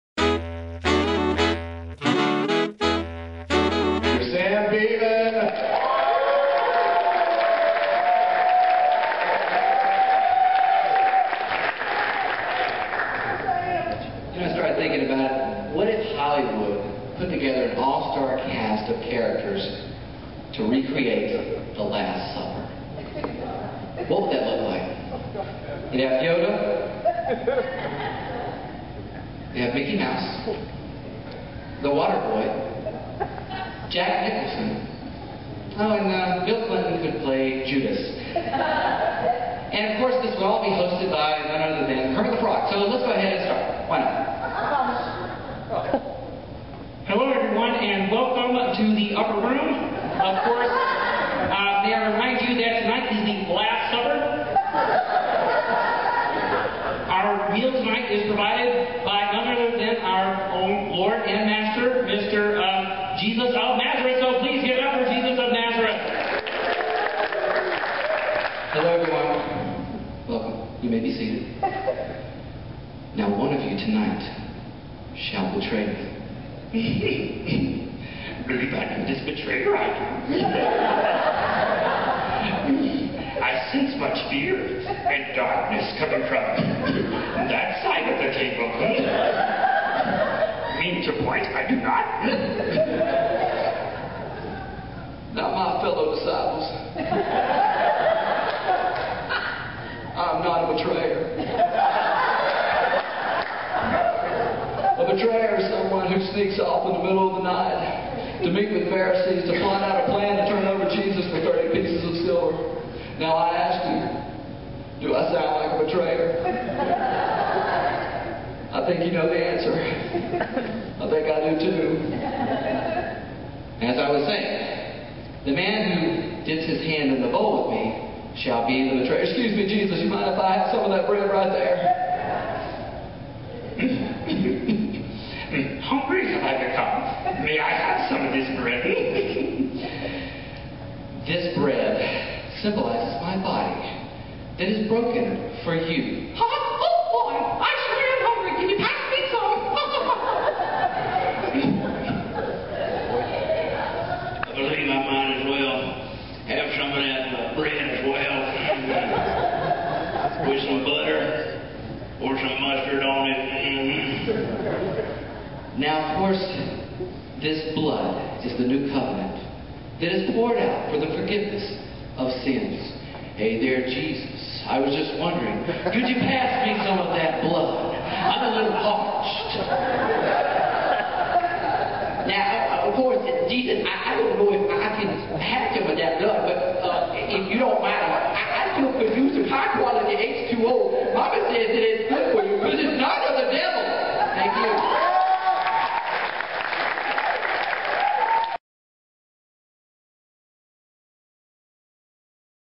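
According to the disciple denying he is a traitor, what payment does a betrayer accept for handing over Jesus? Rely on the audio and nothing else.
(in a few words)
30 pieces of silver.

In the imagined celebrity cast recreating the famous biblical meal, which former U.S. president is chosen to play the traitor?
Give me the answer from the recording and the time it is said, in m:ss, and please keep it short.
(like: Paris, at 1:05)
Bill Clinton, at 0:36.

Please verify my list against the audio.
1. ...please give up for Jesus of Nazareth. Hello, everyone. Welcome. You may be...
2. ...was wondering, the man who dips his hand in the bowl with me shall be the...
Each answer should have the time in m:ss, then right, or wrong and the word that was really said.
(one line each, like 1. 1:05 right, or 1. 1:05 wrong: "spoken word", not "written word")
1. 1:04 right
2. 2:04 wrong: "saying", not "wondering".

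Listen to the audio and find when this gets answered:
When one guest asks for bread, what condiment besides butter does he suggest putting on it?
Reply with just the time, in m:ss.
2:42.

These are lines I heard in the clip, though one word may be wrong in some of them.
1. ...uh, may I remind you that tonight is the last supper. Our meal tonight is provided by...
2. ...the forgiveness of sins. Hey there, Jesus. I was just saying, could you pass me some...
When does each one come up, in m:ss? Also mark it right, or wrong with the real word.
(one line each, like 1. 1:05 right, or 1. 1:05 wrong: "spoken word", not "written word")
1. 0:51 right
2. 2:50 wrong: "wondering", not "saying".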